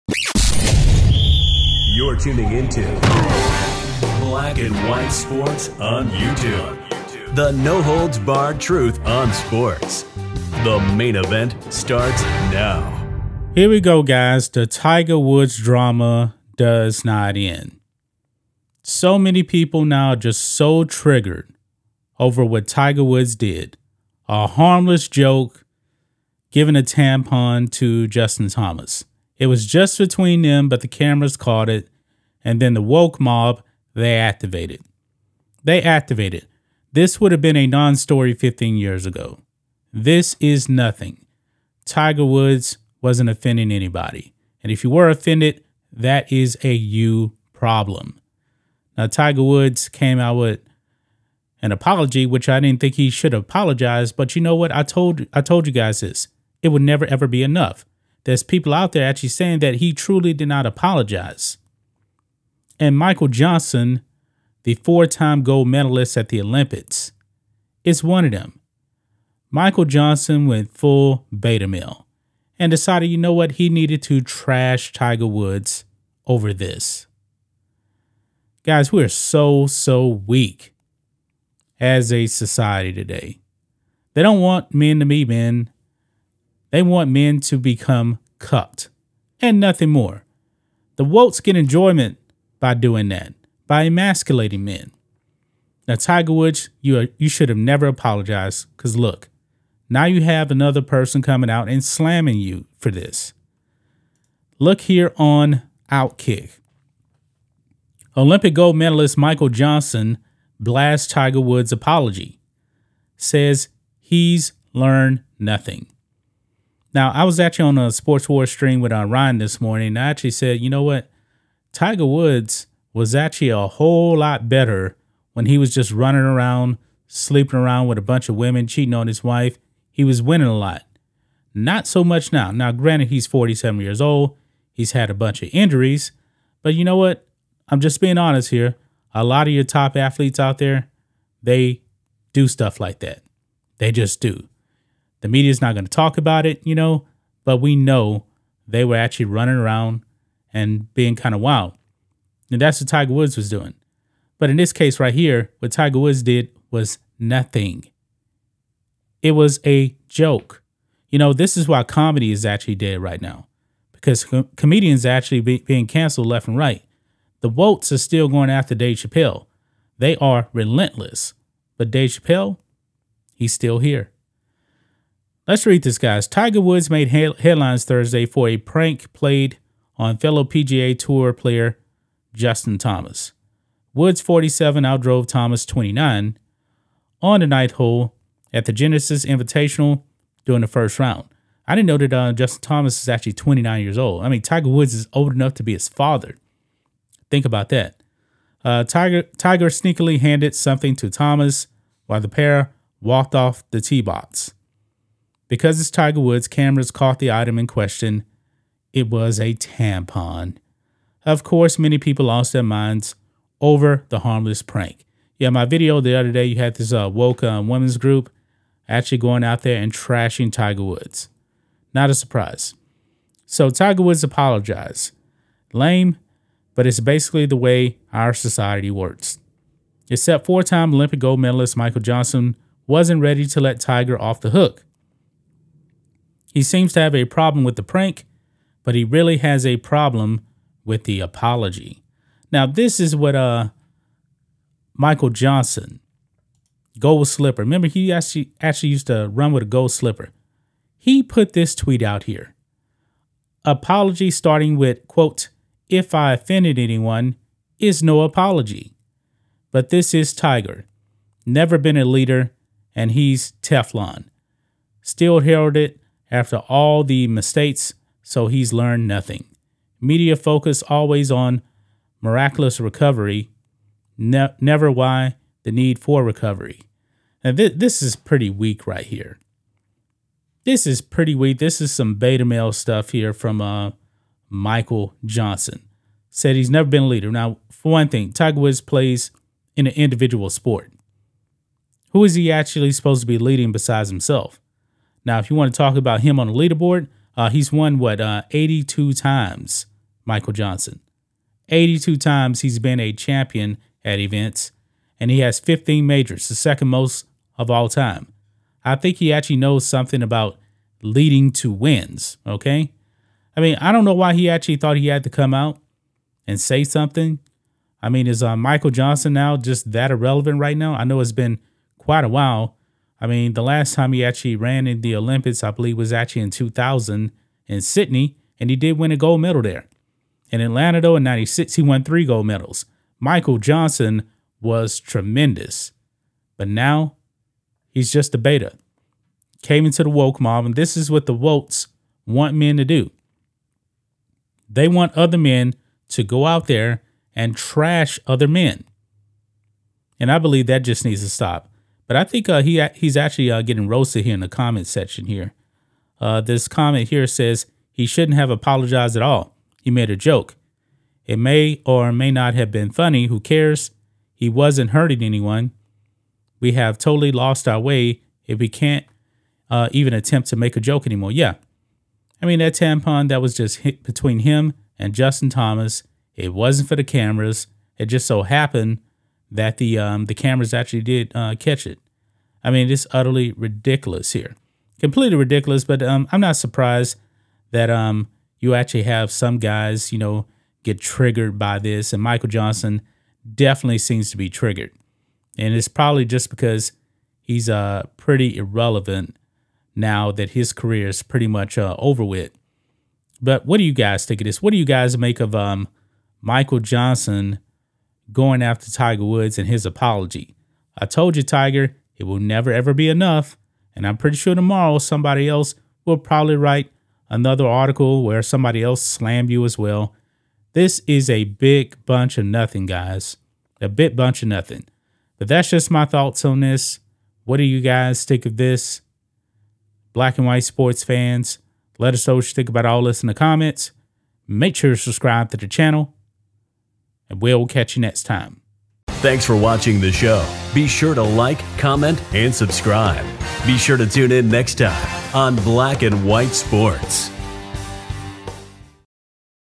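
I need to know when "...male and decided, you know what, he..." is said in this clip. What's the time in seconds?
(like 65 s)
71 s.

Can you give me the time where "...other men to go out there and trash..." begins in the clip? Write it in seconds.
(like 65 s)
345 s.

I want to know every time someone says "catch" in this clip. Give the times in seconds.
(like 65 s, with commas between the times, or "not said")
381 s, 437 s.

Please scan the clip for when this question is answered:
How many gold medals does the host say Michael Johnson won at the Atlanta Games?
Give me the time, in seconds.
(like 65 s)
332 s.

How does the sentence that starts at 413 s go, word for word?
And I'm pretty sure tomorrow somebody else will probably write another article where somebody else slammed you as well.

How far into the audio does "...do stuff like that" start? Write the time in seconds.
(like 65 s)
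142 s.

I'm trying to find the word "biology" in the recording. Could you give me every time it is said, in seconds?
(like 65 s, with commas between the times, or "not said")
not said.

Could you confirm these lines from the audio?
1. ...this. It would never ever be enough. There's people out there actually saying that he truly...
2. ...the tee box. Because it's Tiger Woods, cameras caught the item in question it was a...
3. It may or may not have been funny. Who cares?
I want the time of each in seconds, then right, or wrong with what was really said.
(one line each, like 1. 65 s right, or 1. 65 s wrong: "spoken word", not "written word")
1. 56 s right
2. 203 s right
3. 361 s right.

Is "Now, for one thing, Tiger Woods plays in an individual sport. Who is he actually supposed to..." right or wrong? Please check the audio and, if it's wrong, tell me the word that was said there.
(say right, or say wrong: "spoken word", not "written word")
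right.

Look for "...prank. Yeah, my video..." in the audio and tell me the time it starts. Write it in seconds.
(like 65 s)
214 s.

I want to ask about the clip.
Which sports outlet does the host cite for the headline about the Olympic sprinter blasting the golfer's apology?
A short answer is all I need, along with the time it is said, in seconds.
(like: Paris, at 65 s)
Outkick, at 105 s.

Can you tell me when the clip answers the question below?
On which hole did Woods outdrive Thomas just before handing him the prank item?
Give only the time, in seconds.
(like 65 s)
187 s.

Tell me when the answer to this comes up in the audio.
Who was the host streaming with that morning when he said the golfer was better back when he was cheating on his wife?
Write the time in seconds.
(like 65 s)
119 s.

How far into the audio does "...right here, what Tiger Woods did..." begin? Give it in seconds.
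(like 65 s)
154 s.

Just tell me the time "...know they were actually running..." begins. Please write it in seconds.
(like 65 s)
147 s.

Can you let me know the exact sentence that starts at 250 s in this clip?
He put this tweet out here.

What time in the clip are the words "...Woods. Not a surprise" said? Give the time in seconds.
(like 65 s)
220 s.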